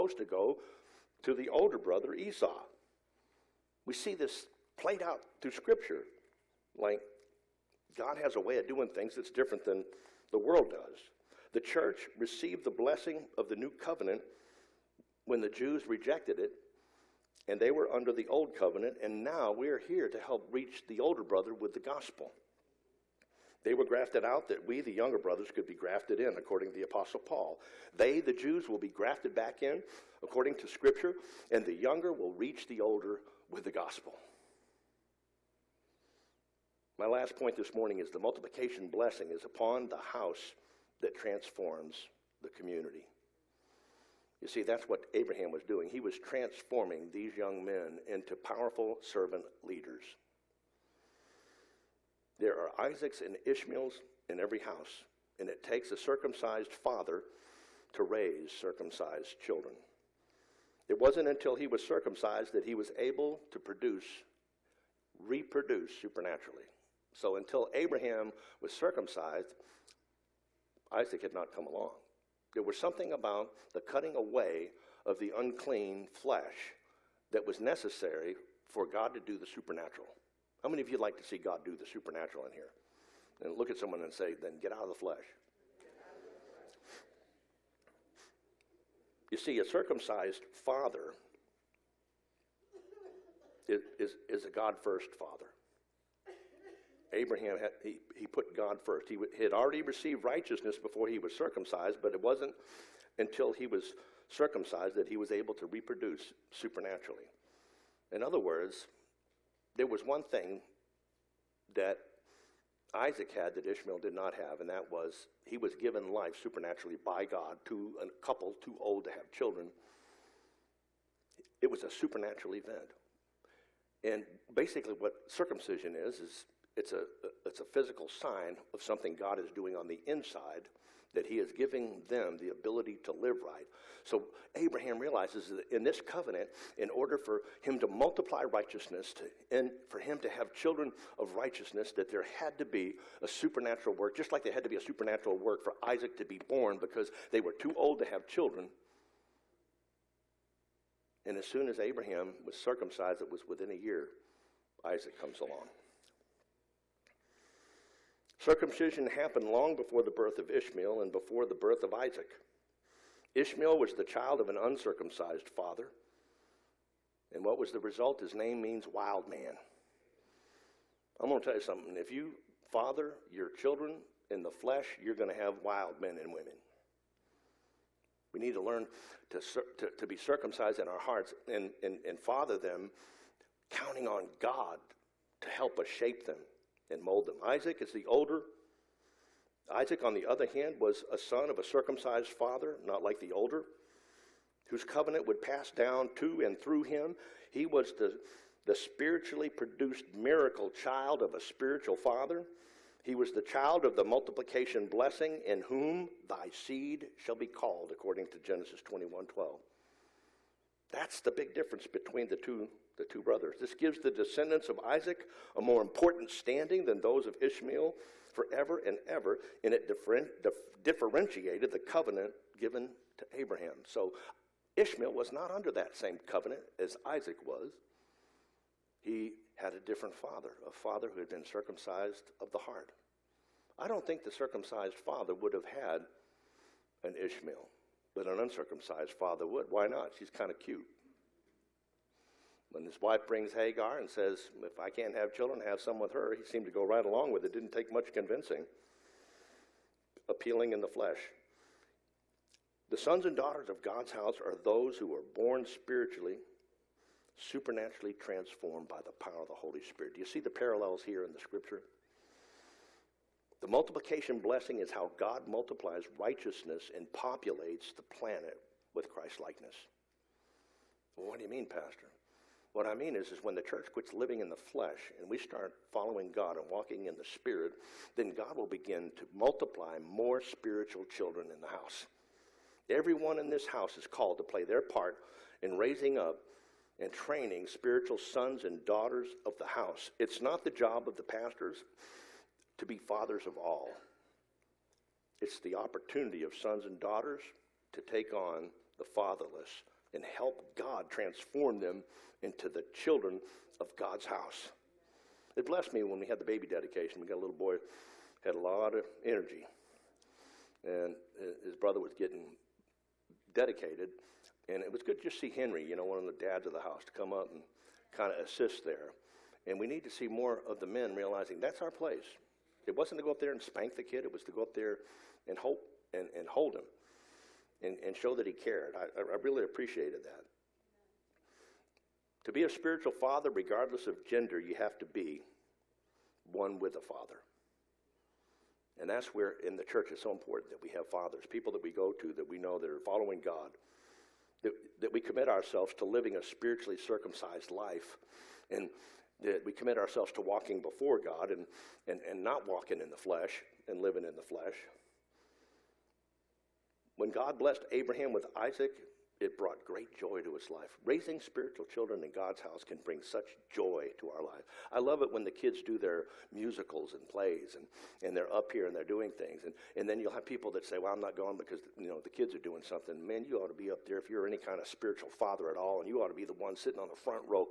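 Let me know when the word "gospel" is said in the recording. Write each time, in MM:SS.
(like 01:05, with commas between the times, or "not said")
00:21, 00:33.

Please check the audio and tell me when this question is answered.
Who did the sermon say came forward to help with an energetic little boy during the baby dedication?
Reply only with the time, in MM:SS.
05:15.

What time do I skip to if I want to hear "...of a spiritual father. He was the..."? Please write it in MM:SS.
03:21.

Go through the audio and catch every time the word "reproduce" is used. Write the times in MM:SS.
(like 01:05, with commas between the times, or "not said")
01:05, 01:45.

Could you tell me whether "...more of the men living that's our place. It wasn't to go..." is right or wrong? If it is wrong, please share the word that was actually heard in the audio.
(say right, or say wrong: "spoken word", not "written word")
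wrong: "realizing", not "living".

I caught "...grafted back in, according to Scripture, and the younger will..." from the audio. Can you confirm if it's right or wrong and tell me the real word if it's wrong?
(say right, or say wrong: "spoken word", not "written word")
right.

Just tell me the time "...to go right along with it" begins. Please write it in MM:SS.
04:06.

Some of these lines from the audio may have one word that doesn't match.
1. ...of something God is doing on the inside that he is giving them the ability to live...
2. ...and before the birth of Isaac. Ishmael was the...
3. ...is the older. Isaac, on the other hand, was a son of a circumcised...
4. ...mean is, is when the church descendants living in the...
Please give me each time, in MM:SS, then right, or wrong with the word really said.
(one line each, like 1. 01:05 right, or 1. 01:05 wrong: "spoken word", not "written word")
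1. 02:08 right
2. 02:41 right
3. 03:07 right
4. 04:32 wrong: "quits", not "descendants".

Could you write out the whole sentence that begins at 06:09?
And, and then you'll have people that say, well, I'm not going because, you know, the kids are doing something.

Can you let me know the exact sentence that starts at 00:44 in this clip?
You see, that's what Abraham was doing.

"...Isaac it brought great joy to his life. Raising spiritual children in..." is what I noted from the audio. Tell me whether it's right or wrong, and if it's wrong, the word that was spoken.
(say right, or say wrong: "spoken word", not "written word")
right.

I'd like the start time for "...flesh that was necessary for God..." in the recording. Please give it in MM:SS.
01:16.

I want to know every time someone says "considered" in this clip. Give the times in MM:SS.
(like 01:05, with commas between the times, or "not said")
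not said.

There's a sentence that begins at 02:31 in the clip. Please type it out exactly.
And as soon as Abraham was circumcised, it was within a year, Isaac comes along.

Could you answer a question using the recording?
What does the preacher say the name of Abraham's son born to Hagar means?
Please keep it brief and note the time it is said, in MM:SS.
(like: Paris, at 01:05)
Wild man, at 02:48.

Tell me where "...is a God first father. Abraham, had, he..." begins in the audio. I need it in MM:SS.
01:34.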